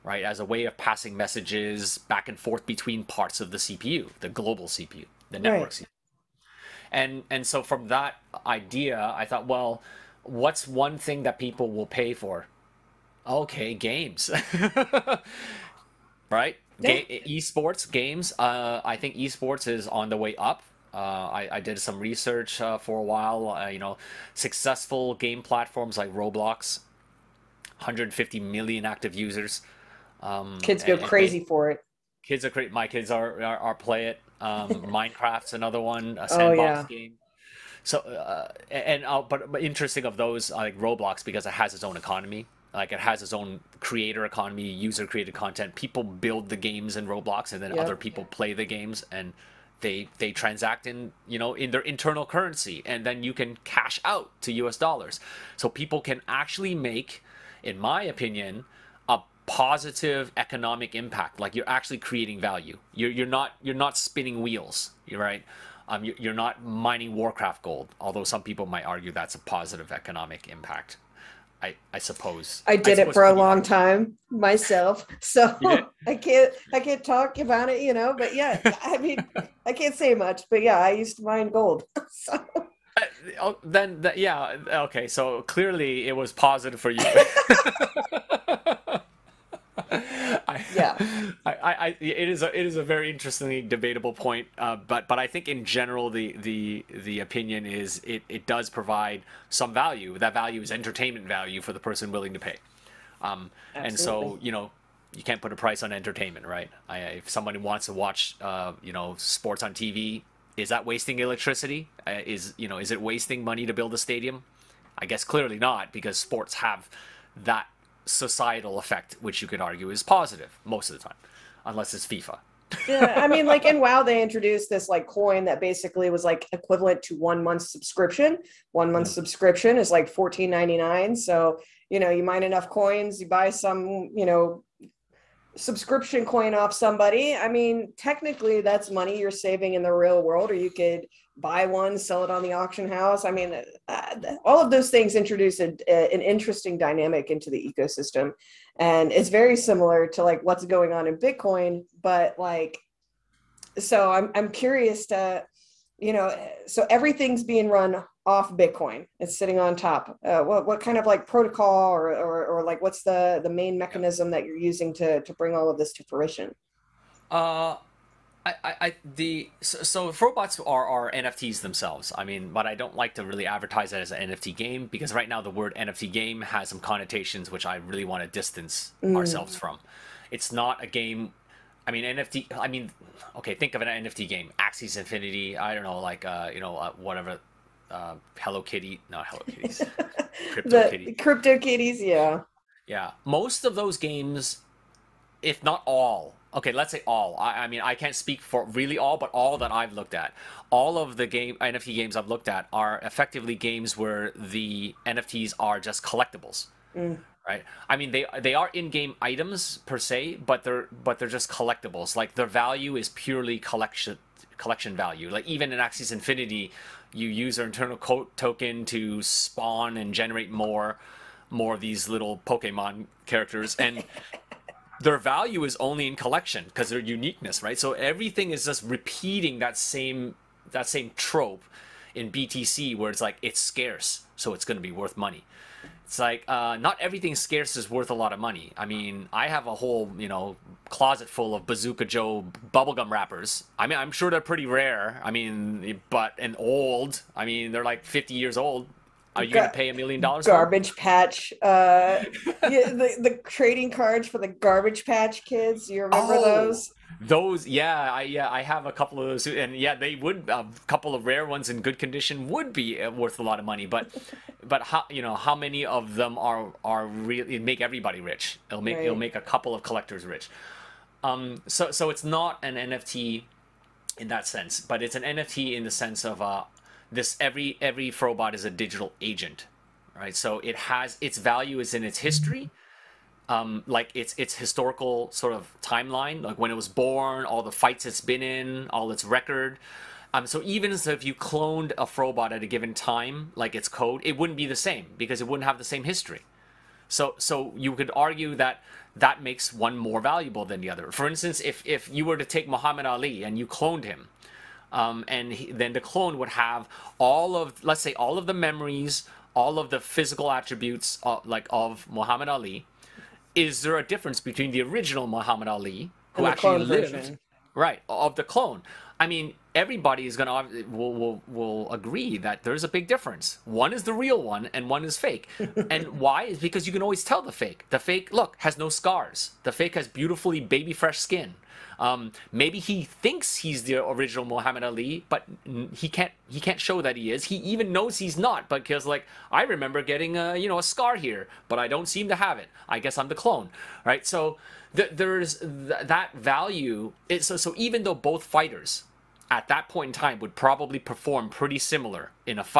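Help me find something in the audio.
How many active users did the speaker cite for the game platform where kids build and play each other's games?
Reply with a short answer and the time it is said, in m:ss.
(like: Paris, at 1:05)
150 million, at 0:27.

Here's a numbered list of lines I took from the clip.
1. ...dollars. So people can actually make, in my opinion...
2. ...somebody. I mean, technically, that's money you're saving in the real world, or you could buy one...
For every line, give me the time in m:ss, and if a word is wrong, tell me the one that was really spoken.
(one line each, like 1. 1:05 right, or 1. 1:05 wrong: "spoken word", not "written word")
1. 0:54 right
2. 2:16 right.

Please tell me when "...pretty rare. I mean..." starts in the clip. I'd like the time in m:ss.
4:04.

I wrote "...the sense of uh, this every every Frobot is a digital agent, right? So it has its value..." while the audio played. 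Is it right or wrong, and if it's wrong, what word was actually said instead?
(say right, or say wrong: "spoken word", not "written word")
right.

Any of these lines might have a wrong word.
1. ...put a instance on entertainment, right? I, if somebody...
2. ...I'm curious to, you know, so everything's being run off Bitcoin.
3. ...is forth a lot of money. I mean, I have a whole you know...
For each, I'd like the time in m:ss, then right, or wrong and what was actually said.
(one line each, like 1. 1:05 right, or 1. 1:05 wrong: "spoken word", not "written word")
1. 1:45 wrong: "price", not "instance"
2. 2:34 right
3. 3:57 wrong: "worth", not "forth".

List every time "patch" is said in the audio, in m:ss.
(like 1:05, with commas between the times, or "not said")
4:10, 4:15.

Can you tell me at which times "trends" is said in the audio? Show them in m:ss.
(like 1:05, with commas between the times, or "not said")
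not said.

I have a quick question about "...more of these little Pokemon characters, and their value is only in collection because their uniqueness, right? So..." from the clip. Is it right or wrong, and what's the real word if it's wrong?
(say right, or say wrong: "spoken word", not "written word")
right.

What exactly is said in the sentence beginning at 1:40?
That value is entertainment value for the person willing to pay.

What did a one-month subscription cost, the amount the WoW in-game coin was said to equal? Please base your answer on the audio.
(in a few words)
$14.99.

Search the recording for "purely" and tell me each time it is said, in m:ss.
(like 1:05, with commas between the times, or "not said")
3:33.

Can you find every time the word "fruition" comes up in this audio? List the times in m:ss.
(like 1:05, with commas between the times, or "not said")
2:46.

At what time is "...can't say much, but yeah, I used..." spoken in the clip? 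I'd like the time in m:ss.
1:19.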